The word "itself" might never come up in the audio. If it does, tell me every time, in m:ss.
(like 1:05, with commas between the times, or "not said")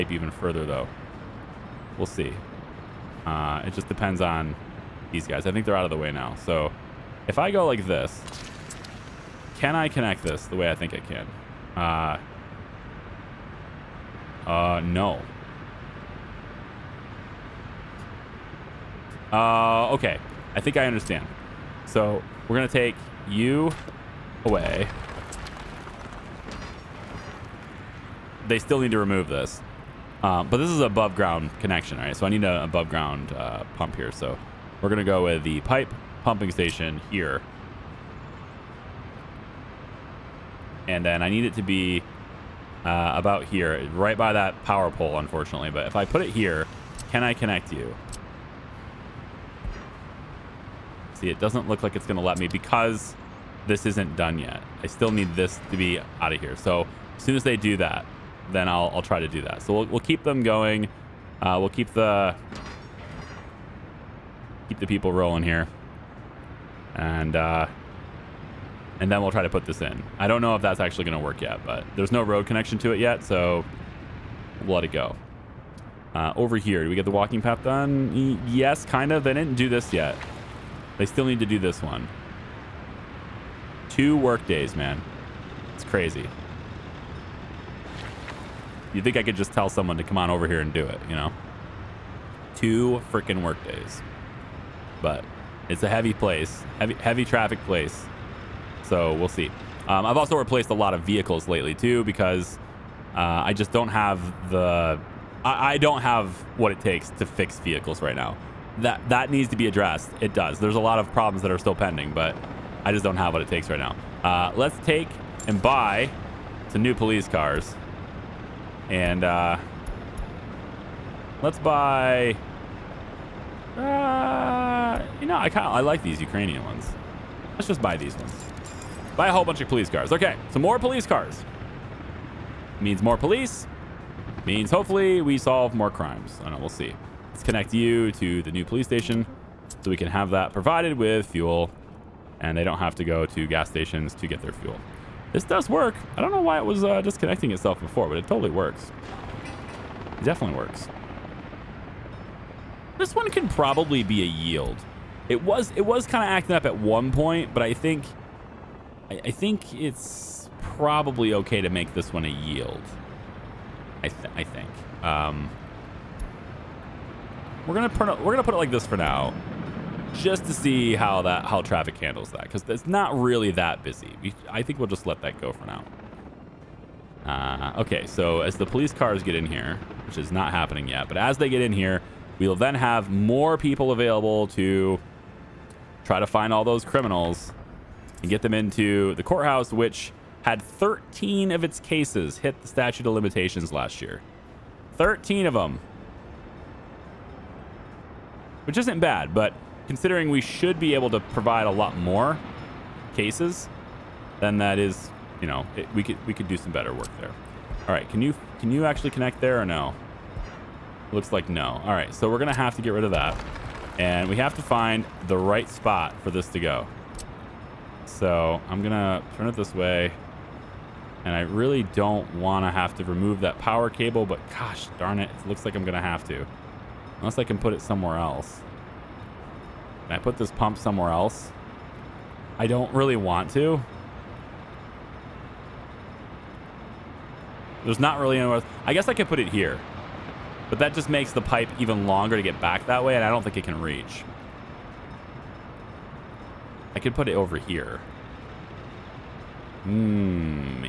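2:27.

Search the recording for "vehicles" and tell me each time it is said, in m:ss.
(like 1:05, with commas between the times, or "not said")
1:41, 1:47.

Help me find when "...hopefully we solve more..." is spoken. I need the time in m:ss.
2:14.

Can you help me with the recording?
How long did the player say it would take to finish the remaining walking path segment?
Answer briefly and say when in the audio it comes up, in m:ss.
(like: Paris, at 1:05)
2 work days, at 1:23.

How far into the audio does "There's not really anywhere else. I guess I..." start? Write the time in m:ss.
3:57.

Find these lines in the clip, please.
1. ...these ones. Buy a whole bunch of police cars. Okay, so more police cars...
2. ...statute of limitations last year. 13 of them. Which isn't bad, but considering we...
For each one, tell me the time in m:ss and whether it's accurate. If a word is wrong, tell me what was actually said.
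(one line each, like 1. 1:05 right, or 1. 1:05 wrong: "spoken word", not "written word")
1. 2:07 right
2. 3:12 right.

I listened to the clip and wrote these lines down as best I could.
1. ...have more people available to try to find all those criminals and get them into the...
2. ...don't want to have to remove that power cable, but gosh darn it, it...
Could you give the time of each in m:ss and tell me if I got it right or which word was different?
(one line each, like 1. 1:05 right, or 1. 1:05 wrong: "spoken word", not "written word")
1. 3:02 right
2. 3:41 right.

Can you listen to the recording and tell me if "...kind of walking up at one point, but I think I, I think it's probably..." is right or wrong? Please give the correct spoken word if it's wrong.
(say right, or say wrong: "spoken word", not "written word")
wrong: "acting", not "walking".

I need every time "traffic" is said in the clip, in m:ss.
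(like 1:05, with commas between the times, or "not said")
1:37, 2:51.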